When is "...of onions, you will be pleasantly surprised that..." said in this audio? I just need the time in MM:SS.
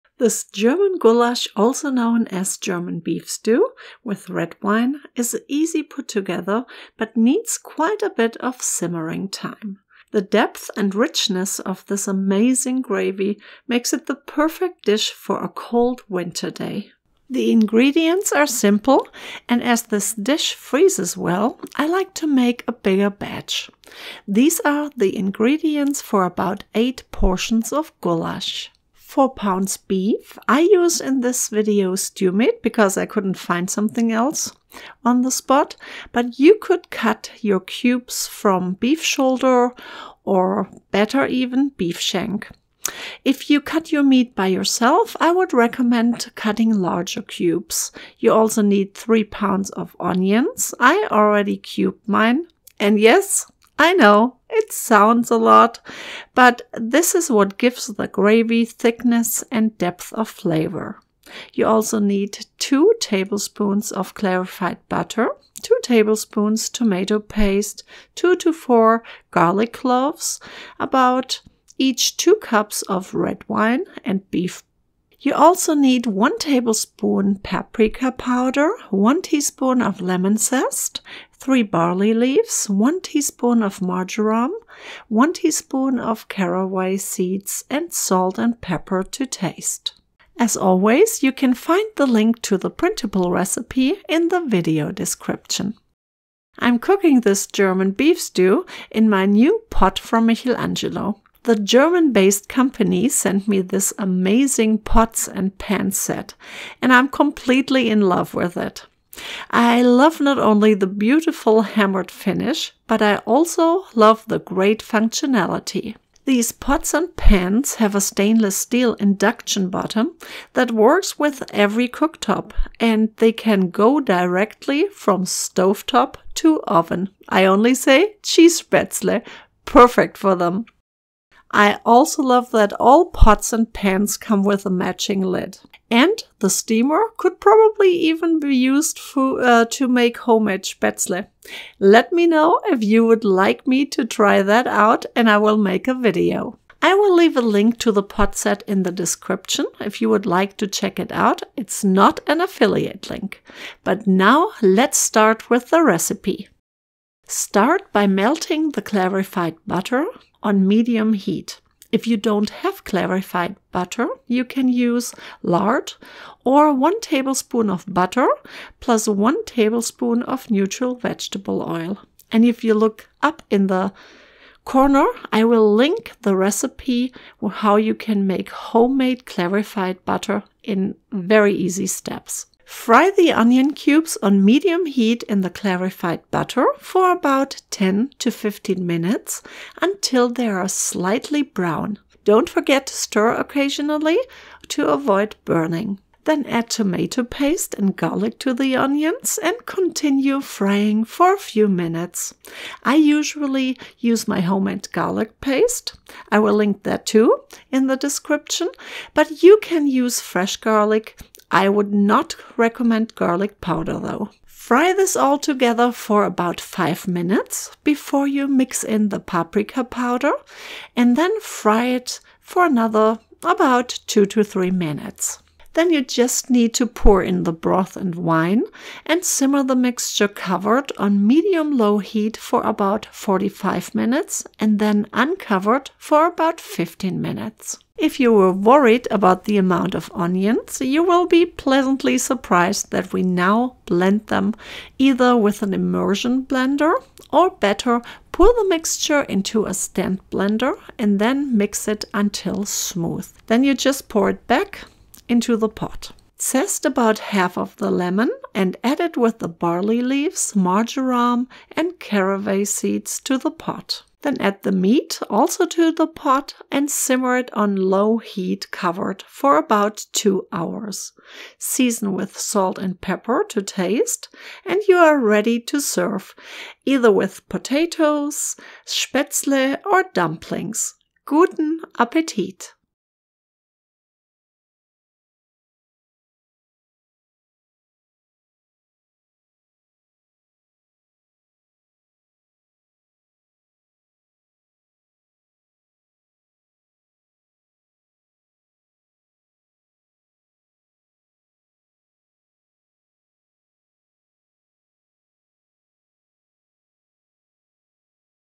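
03:59.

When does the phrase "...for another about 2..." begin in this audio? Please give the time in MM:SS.
03:42.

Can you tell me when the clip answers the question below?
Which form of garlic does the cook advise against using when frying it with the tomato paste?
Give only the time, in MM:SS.
03:33.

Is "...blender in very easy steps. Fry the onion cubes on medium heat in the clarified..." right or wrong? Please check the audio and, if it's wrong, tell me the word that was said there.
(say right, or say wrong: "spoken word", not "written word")
wrong: "butter", not "blender".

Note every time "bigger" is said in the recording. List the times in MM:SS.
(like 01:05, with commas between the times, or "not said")
00:22.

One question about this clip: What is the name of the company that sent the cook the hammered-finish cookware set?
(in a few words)
Michelangelo.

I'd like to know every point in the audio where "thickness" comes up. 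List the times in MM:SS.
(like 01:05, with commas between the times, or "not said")
00:58.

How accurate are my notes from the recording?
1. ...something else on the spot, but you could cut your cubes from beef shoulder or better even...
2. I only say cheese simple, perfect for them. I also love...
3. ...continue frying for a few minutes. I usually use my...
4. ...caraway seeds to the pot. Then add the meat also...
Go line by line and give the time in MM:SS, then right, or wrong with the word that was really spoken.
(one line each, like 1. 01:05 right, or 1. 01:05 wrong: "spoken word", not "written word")
1. 00:33 right
2. 02:07 wrong: "spätzle", not "simple"
3. 03:19 right
4. 04:21 right.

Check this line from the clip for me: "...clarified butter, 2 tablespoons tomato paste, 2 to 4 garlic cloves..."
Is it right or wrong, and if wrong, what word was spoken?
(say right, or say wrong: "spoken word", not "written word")
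right.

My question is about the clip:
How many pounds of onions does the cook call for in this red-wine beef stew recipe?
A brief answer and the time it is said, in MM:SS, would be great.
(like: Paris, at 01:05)
3 pounds, at 00:48.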